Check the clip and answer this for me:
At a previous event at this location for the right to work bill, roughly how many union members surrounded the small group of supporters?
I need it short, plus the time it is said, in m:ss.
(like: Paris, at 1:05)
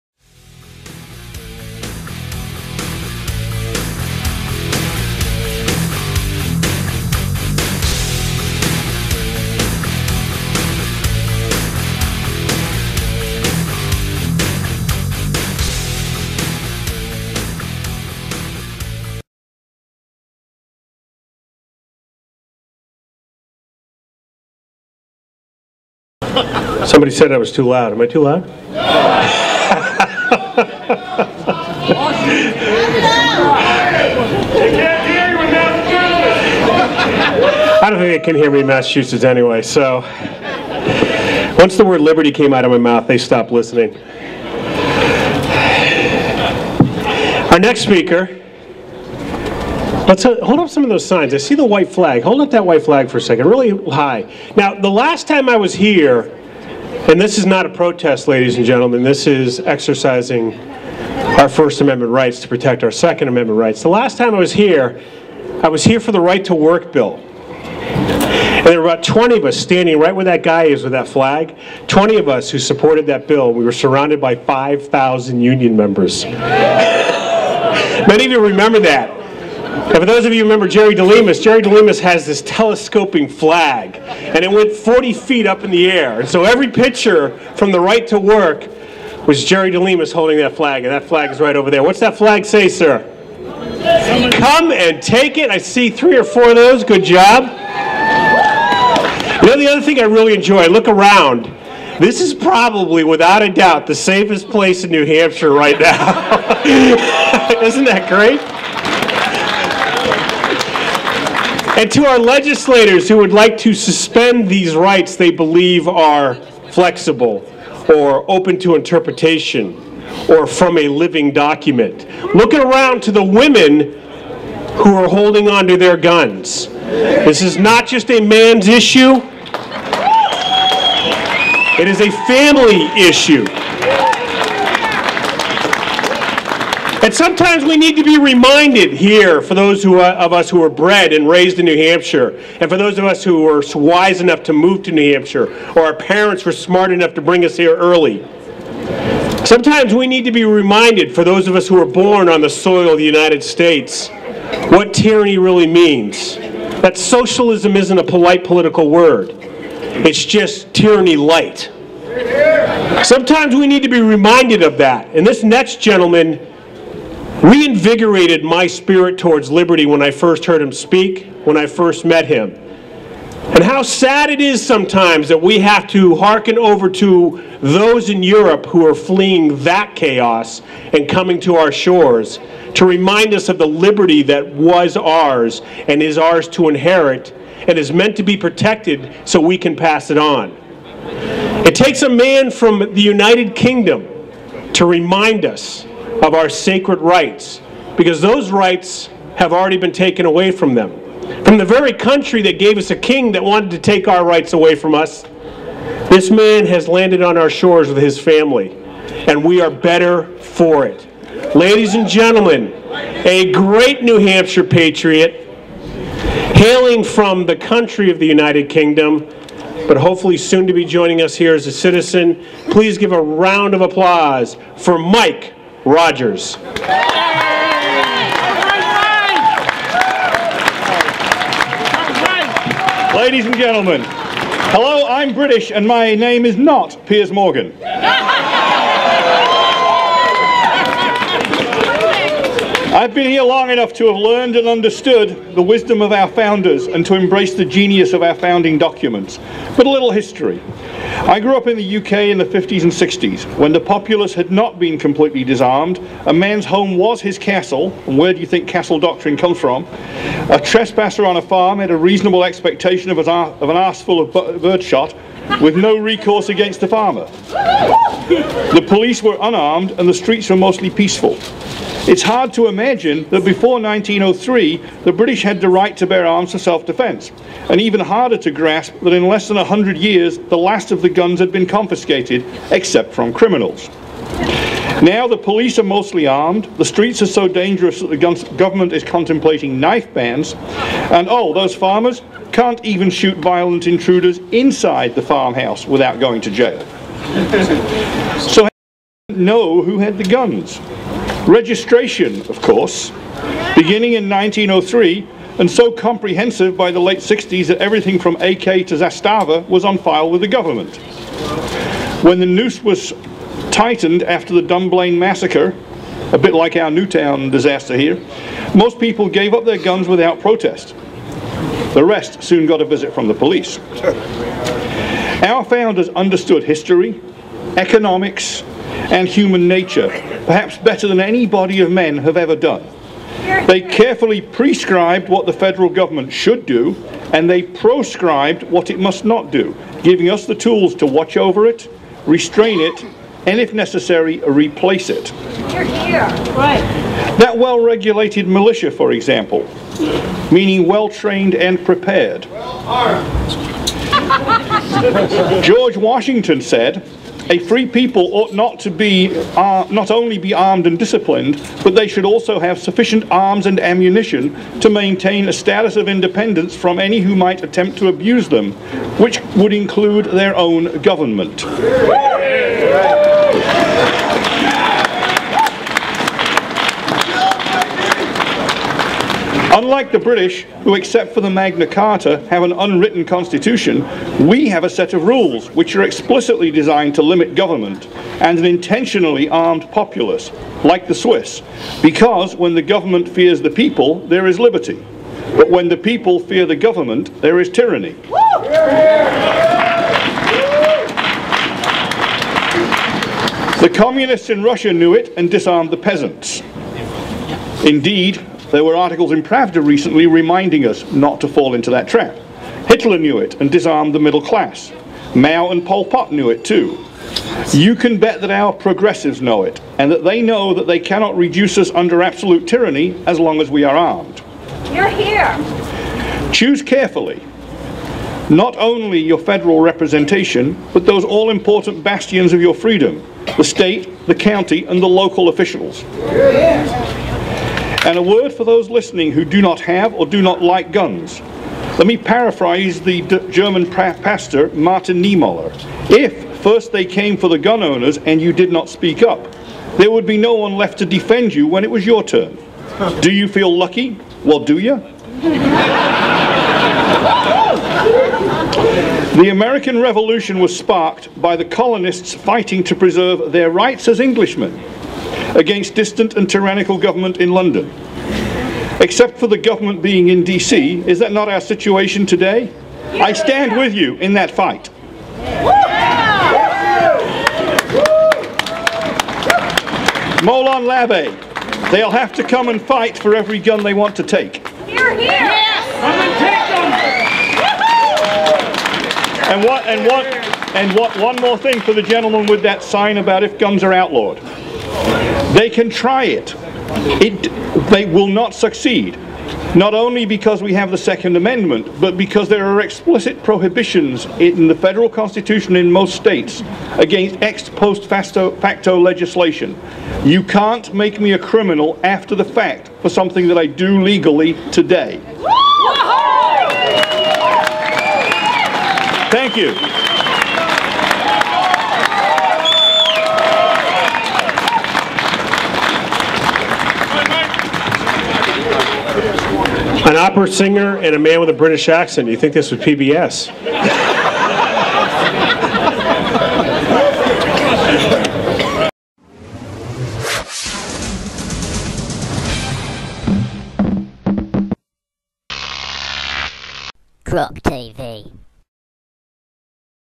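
5,000, at 1:14.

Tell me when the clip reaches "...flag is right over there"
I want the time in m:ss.
1:31.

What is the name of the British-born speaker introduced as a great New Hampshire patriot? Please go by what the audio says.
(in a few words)
Mike Rogers.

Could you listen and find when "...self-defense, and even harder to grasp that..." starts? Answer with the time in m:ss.
4:36.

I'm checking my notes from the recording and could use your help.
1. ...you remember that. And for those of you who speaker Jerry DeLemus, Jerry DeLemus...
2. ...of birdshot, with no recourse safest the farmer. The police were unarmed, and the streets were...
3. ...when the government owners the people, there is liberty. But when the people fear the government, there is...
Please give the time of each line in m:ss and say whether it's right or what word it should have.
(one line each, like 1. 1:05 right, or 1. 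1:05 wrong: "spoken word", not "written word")
1. 1:18 wrong: "remember", not "speaker"
2. 4:24 wrong: "against", not "safest"
3. 6:32 wrong: "fears", not "owners".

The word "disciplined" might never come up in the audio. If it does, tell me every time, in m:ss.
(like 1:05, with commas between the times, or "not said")
6:00.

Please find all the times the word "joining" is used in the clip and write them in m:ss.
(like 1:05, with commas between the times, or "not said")
3:40.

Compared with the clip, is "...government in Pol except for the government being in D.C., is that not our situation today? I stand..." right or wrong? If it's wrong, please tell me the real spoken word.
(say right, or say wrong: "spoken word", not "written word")
wrong: "London", not "Pol".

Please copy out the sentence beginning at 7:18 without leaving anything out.
And a word for those listening who do not have or do not like guns.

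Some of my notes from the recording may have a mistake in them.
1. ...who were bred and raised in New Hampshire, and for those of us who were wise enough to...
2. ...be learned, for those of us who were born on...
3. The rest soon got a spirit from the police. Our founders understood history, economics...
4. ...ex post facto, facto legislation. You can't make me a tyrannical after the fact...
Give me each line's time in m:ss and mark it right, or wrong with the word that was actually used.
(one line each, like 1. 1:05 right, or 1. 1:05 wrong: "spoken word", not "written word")
1. 2:20 right
2. 2:30 wrong: "reminded", not "learned"
3. 5:21 wrong: "visit", not "spirit"
4. 8:27 wrong: "criminal", not "tyrannical".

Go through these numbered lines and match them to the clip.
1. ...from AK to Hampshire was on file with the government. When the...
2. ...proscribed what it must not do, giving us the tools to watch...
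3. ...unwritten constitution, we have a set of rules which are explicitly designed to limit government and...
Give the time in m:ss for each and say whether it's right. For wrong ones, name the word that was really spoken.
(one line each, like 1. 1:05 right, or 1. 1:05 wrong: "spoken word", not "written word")
1. 5:08 wrong: "Zastava", not "Hampshire"
2. 5:37 right
3. 6:22 right.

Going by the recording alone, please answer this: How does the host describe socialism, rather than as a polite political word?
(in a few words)
tyranny light.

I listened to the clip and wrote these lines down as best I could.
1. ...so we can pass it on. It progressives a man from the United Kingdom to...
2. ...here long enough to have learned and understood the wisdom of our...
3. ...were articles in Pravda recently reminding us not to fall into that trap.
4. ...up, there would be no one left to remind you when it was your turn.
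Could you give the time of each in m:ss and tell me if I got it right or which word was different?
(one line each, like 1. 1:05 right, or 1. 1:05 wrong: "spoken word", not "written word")
1. 3:09 wrong: "takes", not "progressives"
2. 4:03 right
3. 6:48 right
4. 7:29 wrong: "defend", not "remind".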